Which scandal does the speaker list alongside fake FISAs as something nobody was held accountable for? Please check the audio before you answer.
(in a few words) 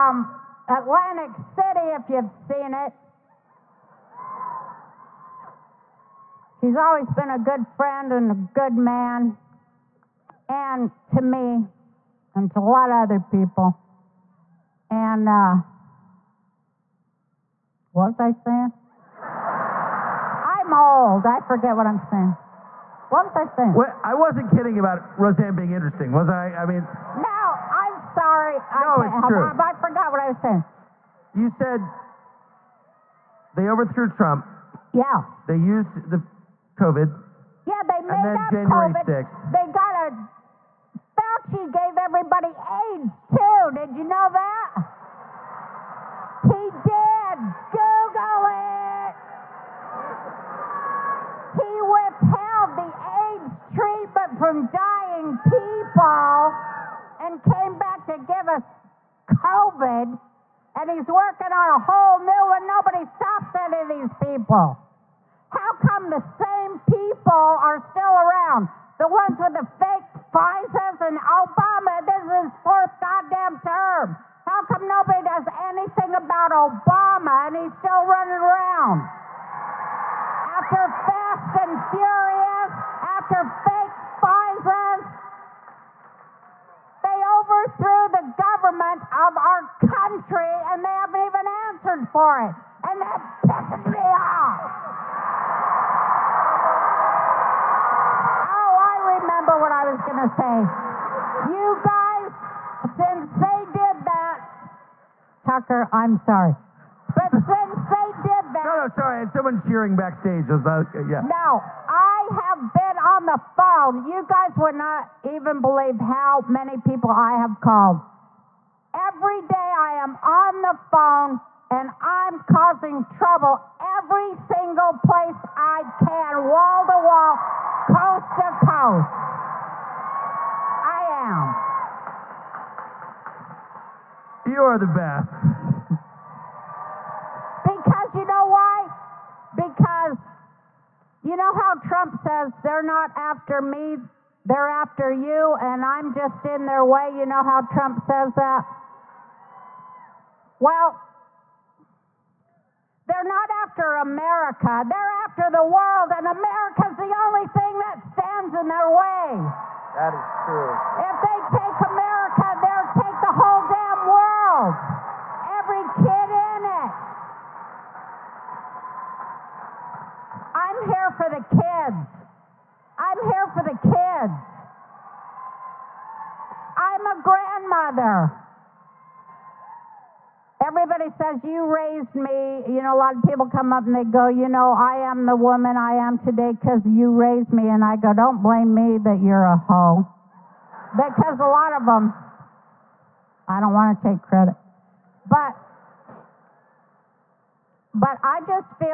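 Fast and Furious.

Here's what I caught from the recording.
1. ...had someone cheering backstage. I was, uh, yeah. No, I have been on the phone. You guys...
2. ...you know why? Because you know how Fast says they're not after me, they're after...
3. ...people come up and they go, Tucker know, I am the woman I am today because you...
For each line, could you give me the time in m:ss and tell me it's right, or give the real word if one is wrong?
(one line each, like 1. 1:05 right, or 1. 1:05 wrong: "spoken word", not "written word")
1. 1:49 right
2. 2:18 wrong: "Trump", not "Fast"
3. 3:03 wrong: "You", not "Tucker".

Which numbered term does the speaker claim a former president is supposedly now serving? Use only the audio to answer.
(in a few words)
fourth.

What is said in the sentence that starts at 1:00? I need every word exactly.
And he's working on a whole new one.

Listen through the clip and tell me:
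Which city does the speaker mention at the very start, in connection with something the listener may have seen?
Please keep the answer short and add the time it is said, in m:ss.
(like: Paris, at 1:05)
Atlantic City, at 0:00.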